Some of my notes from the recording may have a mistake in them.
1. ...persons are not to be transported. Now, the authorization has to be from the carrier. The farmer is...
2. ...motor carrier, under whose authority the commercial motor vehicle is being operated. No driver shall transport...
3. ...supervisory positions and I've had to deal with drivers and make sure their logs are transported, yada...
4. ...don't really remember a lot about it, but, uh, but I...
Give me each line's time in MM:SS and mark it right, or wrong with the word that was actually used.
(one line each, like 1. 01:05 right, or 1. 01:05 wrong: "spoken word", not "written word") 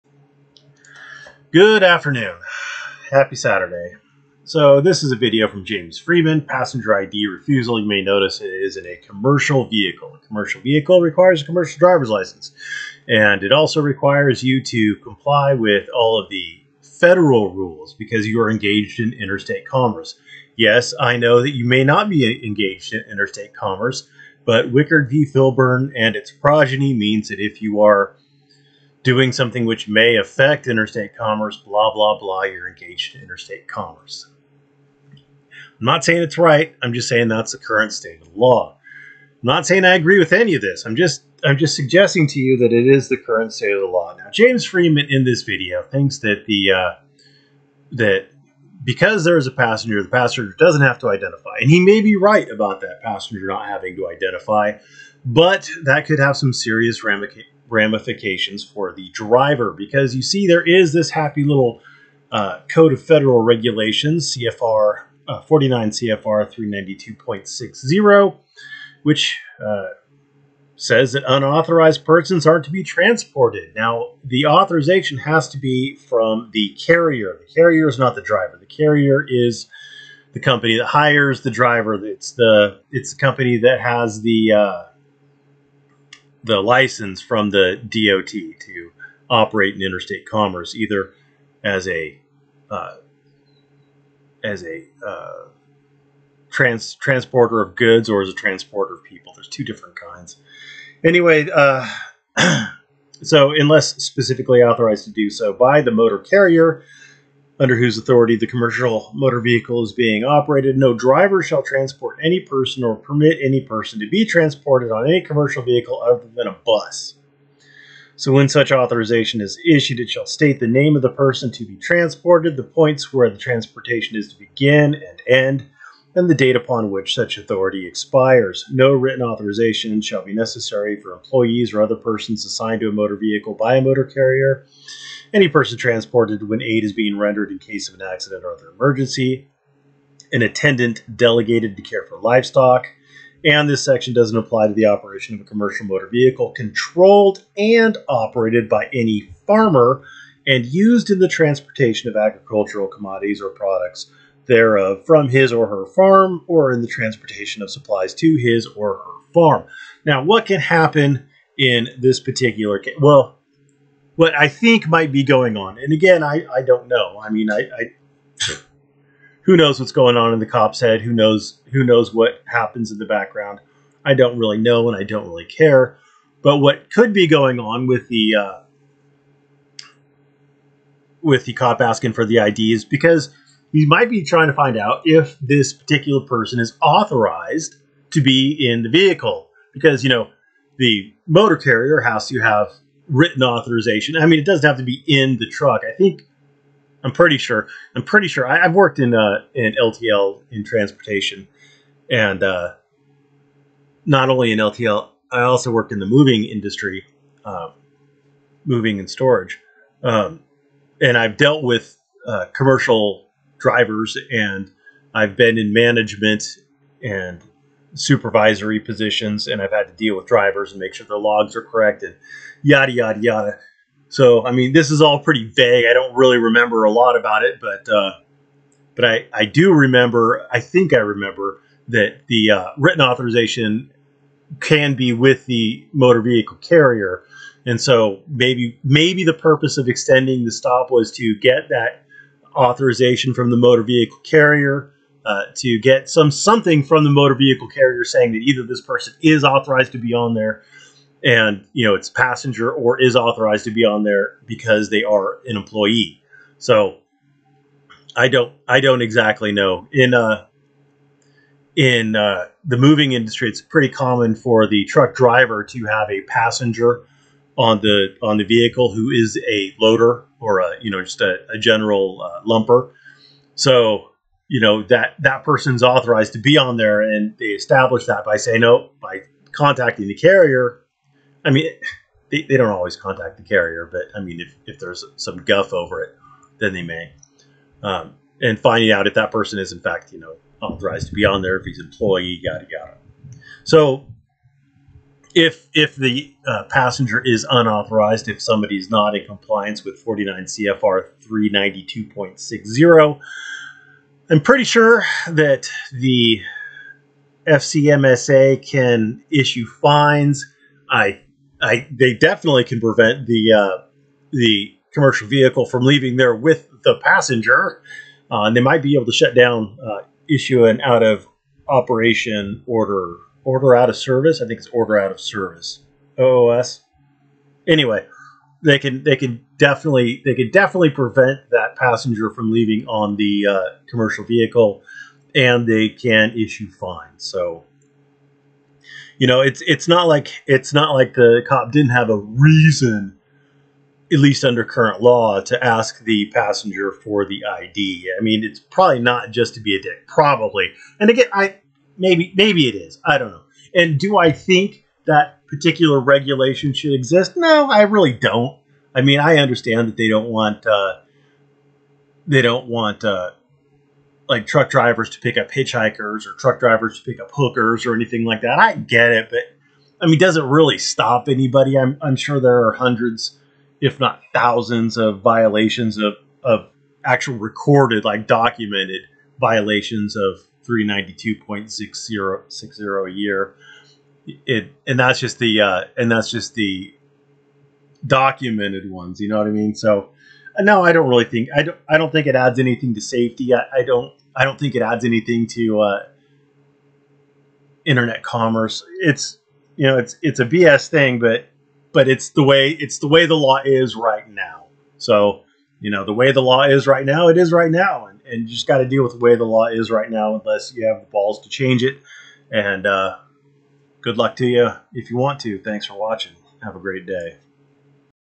1. 01:12 wrong: "carrier", not "farmer"
2. 01:45 right
3. 03:37 wrong: "corrected", not "transported"
4. 03:45 right.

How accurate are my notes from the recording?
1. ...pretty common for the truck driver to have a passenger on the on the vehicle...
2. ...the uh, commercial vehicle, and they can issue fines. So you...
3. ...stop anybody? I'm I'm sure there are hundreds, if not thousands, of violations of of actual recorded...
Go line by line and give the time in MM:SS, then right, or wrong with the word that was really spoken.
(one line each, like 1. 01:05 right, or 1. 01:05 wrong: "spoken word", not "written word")
1. 04:23 right
2. 05:33 right
3. 06:10 right.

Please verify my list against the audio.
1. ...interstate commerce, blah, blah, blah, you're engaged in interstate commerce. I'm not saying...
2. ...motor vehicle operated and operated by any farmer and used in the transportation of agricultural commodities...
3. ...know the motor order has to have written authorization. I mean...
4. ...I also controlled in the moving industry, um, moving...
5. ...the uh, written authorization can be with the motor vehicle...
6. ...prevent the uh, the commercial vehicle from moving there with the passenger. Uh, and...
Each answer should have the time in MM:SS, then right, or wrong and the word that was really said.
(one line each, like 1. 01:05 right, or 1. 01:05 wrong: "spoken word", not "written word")
1. 00:30 right
2. 02:25 wrong: "controlled", not "operated"
3. 03:10 wrong: "carrier", not "order"
4. 03:25 wrong: "worked", not "controlled"
5. 03:52 right
6. 05:12 wrong: "leaving", not "moving".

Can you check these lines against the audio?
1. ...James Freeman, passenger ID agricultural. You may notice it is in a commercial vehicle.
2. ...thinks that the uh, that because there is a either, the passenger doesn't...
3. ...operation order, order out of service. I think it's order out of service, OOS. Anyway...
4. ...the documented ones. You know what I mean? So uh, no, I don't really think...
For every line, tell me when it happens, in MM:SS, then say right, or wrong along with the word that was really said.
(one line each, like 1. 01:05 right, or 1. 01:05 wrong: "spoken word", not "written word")
1. 00:05 wrong: "refusal", not "agricultural"
2. 00:45 wrong: "passenger", not "either"
3. 05:21 right
4. 06:26 right.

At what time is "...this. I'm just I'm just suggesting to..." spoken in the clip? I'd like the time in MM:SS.
00:40.